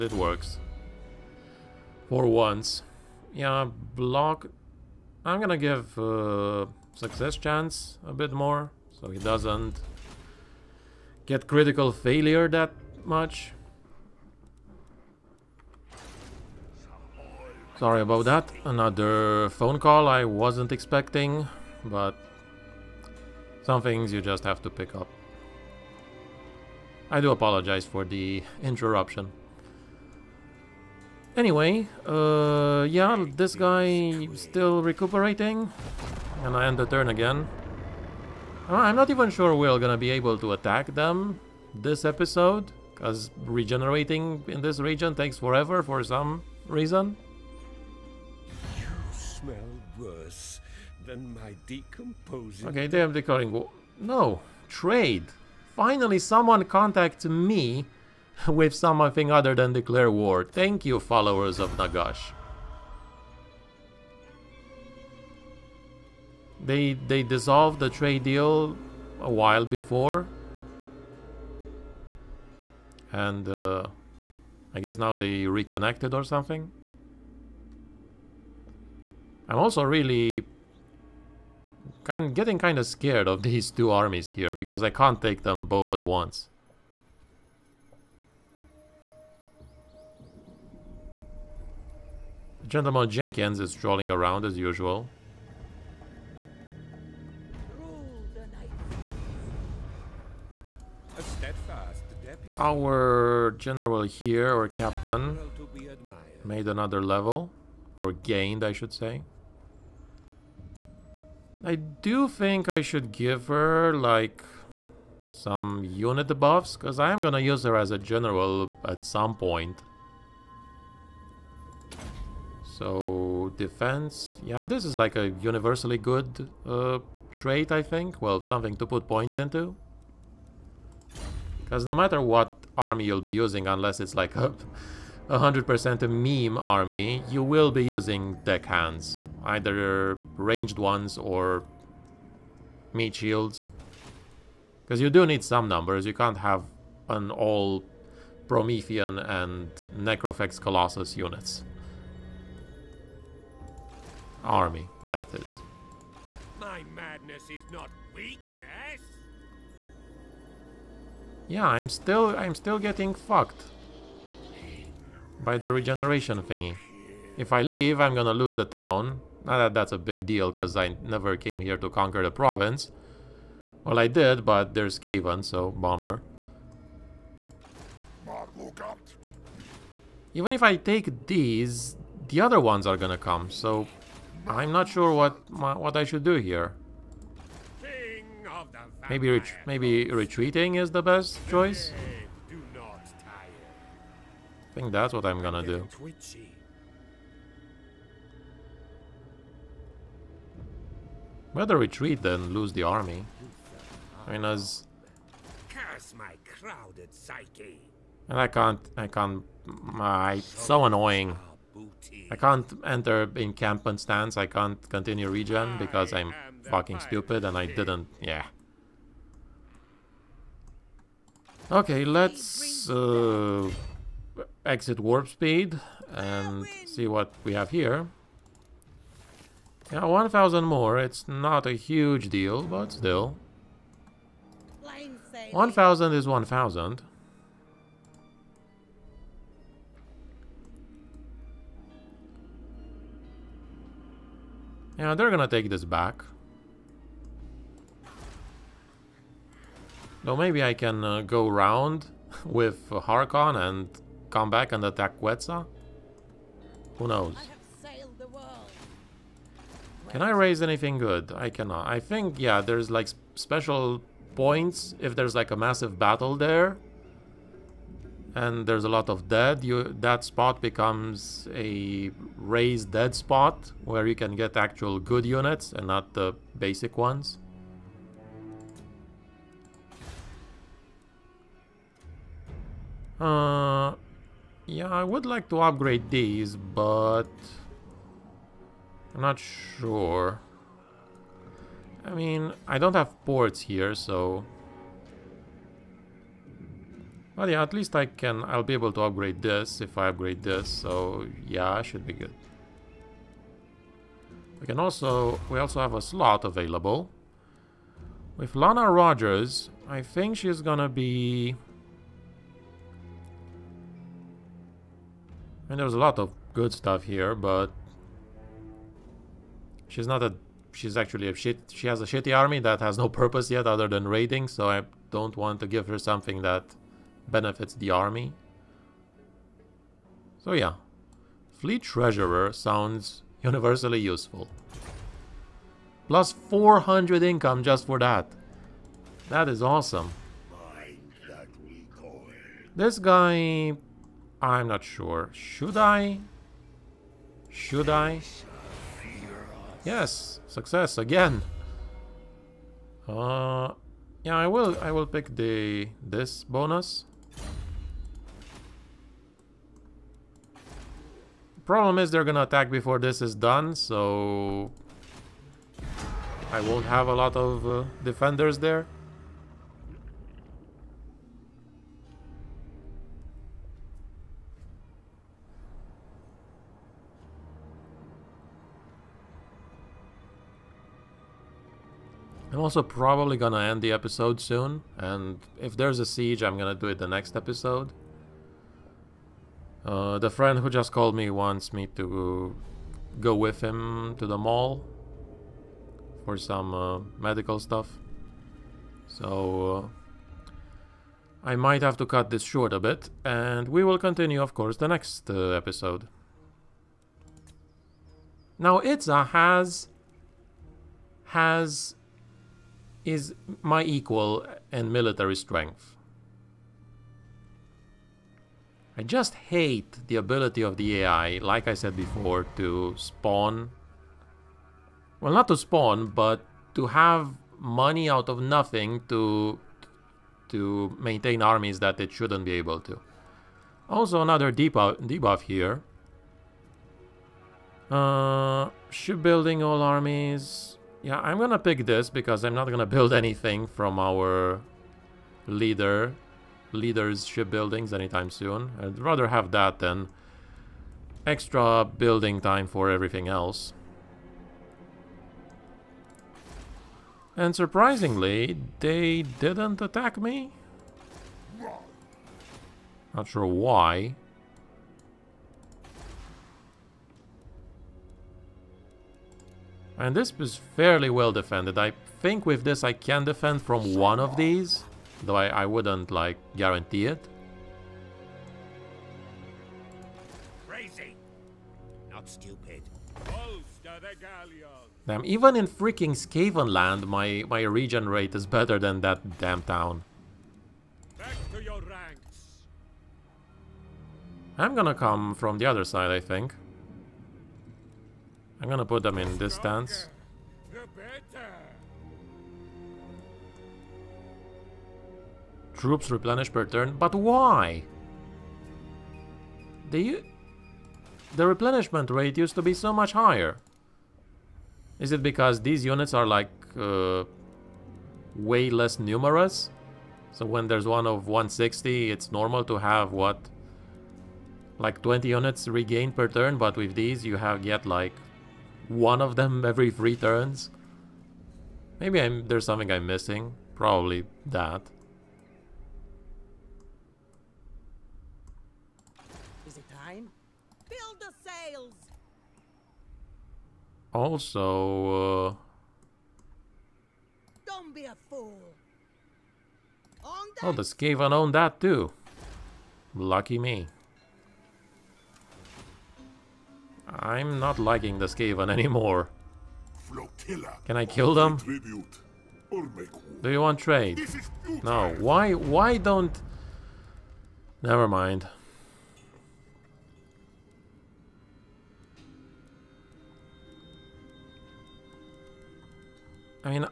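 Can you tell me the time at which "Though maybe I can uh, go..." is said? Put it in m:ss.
4:10.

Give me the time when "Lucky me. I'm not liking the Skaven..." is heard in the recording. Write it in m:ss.
9:13.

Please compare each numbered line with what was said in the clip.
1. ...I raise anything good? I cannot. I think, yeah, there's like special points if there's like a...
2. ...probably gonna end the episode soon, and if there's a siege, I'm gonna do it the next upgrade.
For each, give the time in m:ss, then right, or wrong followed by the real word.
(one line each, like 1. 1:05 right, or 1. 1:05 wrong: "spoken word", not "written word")
1. 4:20 right
2. 6:22 wrong: "episode", not "upgrade".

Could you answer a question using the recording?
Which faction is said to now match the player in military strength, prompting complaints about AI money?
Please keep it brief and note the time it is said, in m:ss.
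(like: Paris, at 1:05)
Itza, at 6:48.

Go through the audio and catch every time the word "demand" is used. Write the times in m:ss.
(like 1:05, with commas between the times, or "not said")
not said.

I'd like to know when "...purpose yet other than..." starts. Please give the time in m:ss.
5:23.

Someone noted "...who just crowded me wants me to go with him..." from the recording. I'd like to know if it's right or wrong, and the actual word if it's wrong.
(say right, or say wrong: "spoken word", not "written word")
wrong: "called", not "crowded".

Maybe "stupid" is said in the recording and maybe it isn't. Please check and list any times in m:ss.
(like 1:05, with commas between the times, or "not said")
3:36, 8:02.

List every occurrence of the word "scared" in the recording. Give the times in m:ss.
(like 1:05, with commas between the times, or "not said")
1:22.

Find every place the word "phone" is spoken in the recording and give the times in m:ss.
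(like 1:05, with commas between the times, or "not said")
0:19.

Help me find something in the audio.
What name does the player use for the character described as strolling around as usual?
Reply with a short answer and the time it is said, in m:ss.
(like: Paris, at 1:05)
Gentleman Jenkins, at 1:32.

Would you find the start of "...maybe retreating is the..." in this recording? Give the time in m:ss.
3:09.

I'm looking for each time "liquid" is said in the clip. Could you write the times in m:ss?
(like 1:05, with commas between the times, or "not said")
not said.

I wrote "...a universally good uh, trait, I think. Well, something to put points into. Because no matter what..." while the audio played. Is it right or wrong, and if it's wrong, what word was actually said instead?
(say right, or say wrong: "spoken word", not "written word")
right.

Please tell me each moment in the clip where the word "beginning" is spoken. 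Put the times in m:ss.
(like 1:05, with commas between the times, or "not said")
not said.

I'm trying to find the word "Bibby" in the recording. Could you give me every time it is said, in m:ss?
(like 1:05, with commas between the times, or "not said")
not said.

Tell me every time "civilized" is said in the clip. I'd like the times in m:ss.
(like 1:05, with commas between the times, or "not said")
not said.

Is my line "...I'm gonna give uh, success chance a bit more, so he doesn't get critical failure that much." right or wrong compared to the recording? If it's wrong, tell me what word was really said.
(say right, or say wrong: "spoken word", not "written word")
right.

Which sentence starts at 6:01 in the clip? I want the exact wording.
Problem is they're gonna attack before this is done, so...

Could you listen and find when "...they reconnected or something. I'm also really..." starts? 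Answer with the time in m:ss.
1:15.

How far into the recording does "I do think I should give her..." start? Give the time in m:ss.
1:51.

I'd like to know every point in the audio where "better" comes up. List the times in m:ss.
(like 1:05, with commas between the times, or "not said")
3:21, 8:08.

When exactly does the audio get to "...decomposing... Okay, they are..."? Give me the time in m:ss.
0:51.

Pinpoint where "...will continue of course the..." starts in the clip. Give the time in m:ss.
6:43.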